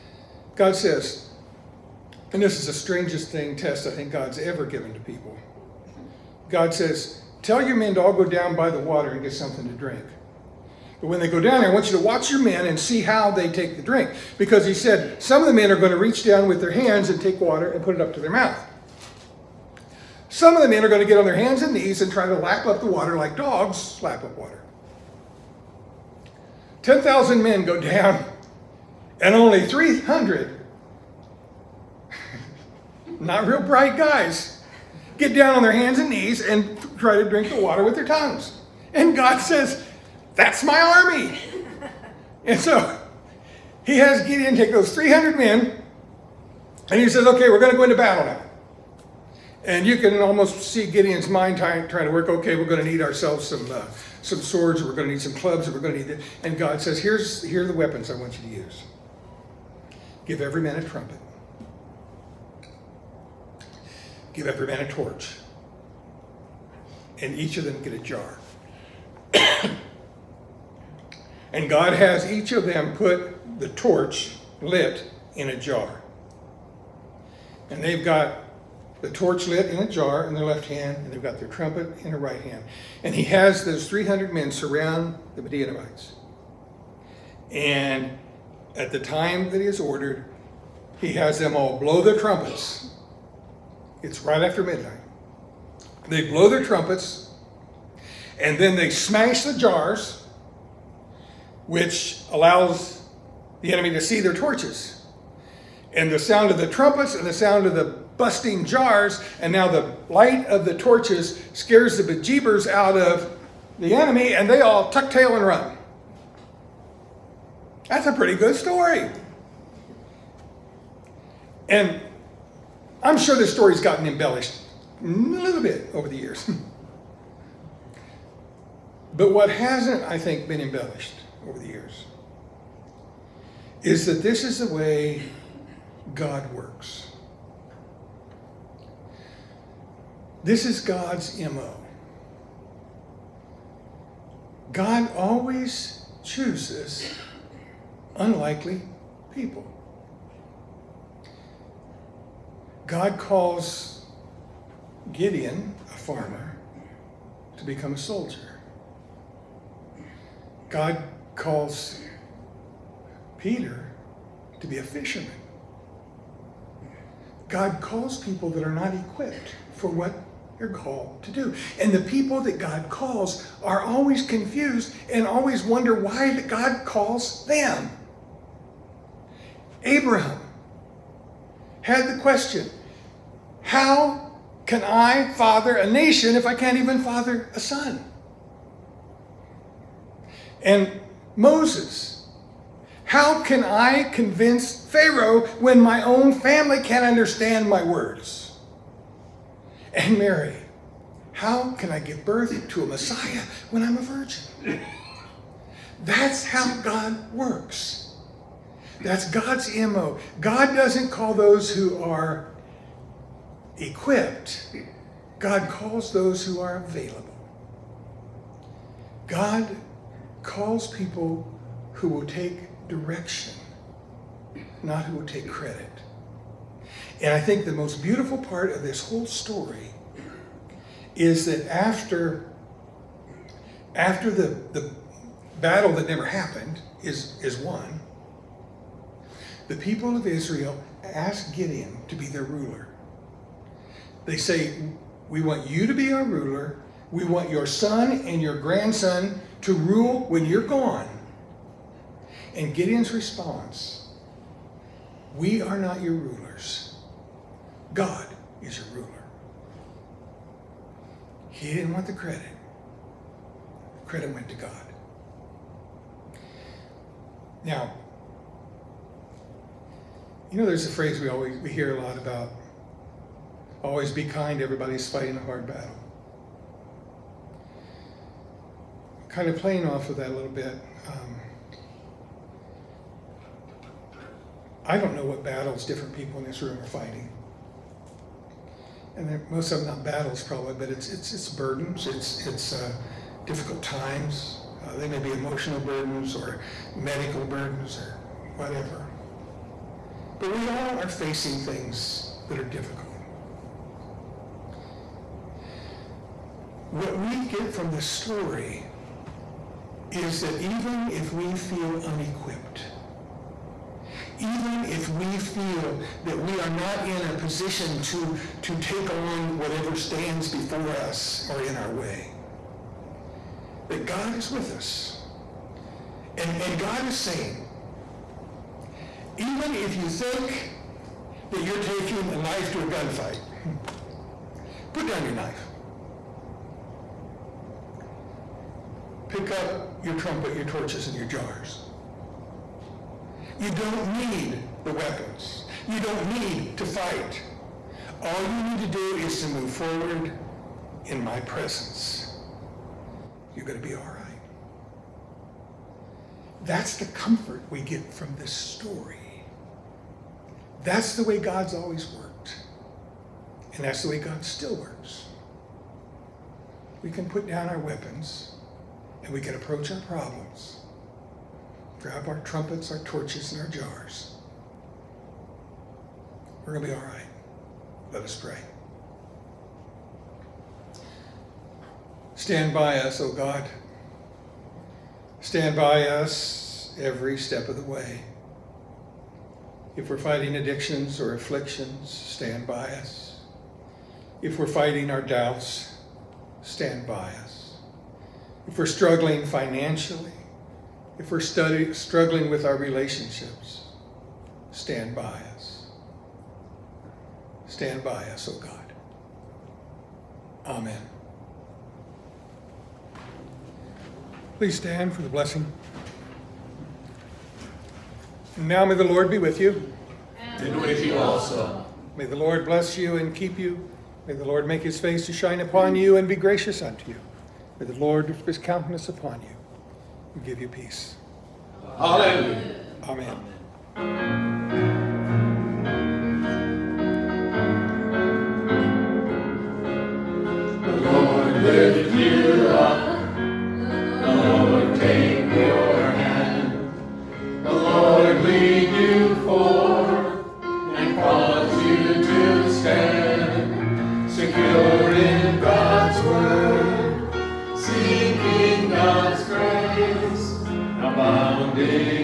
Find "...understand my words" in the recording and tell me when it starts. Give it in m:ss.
3:17.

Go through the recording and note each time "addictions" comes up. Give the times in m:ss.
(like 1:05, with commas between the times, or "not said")
6:30.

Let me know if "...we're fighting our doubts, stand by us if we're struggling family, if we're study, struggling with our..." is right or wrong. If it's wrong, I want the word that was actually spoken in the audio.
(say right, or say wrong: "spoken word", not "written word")
wrong: "financially", not "family".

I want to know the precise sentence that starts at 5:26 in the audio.
And, and God is saying, even if you think that you're taking a knife to a gunfight, put down your knife.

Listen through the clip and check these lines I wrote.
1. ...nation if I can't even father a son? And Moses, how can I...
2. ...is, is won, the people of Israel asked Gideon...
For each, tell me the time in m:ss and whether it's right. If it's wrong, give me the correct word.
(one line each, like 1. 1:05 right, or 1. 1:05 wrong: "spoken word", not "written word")
1. 3:05 right
2. 3:57 right.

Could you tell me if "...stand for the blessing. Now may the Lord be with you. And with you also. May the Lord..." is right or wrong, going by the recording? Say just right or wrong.
right.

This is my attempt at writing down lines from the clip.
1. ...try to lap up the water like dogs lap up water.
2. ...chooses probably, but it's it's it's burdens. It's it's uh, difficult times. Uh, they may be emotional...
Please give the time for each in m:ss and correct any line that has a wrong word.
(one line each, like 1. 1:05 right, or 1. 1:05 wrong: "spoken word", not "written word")
1. 0:22 right
2. 4:50 wrong: "battles", not "chooses".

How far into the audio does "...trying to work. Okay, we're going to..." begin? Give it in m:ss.
0:51.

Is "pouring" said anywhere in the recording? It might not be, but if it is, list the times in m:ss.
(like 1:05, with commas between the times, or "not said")
not said.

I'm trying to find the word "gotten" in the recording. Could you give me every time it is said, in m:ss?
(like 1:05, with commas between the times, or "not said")
2:03.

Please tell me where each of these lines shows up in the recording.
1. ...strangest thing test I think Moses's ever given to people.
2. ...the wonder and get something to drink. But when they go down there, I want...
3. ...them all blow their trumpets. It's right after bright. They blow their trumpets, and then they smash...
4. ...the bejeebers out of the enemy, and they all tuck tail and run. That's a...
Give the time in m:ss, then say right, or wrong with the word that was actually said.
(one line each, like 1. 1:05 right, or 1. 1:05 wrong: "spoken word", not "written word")
1. 0:02 wrong: "God", not "Moses"
2. 0:08 wrong: "water", not "wonder"
3. 1:31 wrong: "midnight", not "bright"
4. 1:51 right.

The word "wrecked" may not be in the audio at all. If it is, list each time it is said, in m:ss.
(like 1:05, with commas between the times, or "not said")
not said.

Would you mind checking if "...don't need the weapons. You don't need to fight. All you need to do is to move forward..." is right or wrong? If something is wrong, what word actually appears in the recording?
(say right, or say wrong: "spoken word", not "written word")
right.